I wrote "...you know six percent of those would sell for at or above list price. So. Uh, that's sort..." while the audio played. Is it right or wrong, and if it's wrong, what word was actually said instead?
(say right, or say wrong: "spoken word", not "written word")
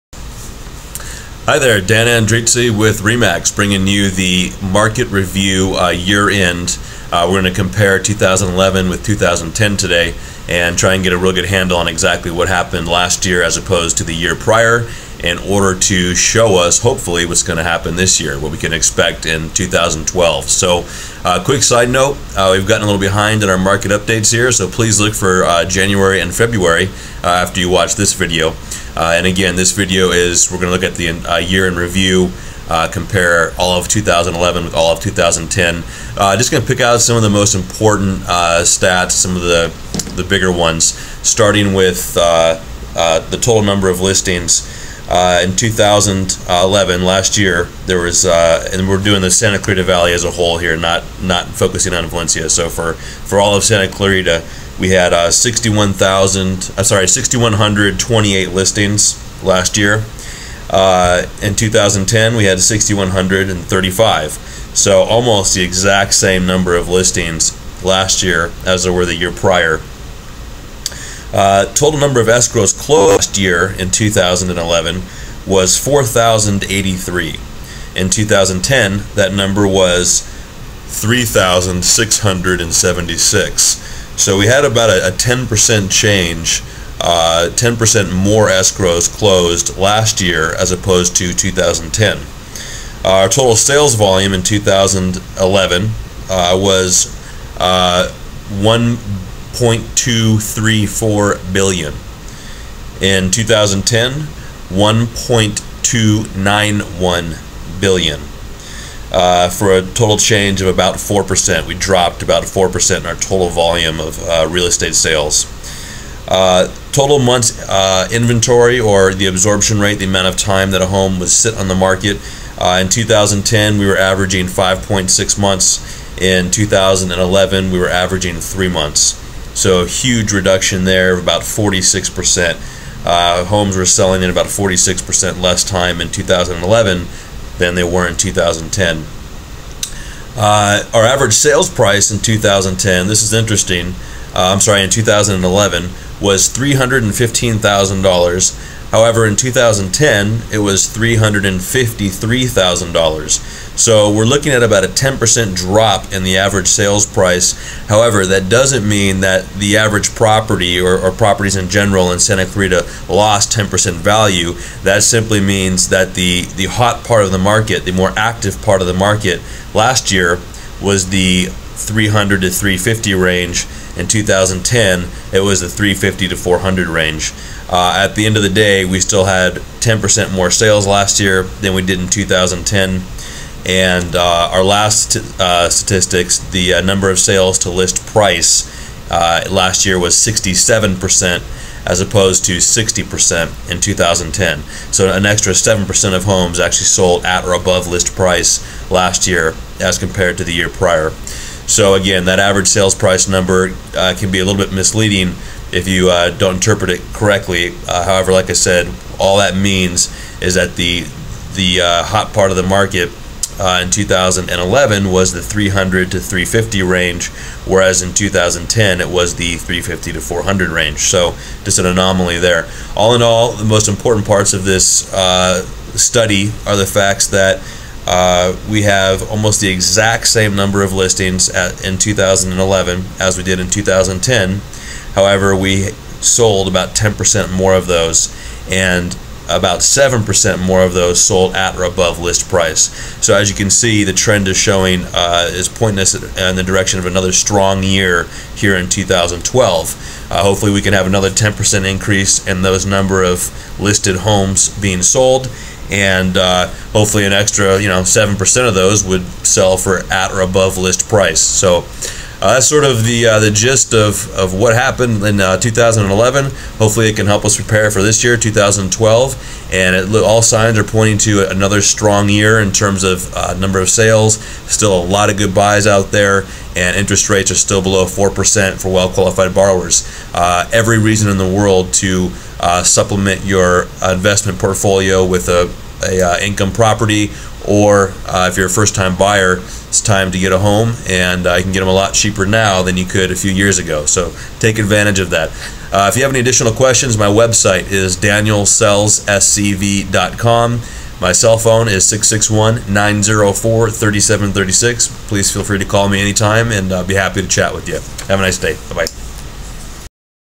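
wrong: "seven", not "six".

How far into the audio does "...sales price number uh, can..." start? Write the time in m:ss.
3:22.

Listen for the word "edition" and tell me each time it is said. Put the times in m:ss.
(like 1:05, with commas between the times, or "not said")
not said.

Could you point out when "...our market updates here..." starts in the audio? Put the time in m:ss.
0:23.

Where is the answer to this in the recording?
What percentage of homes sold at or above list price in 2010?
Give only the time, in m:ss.
3:12.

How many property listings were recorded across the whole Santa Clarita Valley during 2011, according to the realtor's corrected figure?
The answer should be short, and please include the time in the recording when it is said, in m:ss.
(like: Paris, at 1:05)
6,128, at 0:57.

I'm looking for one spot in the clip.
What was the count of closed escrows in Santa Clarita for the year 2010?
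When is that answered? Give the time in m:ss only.
1:20.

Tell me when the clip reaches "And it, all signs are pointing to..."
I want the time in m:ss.
4:29.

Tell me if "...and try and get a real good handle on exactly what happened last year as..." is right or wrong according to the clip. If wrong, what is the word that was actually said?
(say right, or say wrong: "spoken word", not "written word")
right.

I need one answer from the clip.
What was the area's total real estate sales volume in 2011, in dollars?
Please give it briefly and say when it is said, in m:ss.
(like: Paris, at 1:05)
1.234 billion, at 1:38.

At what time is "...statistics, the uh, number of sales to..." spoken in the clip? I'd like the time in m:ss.
3:05.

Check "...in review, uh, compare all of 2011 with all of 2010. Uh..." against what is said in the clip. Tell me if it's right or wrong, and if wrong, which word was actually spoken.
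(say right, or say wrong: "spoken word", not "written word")
right.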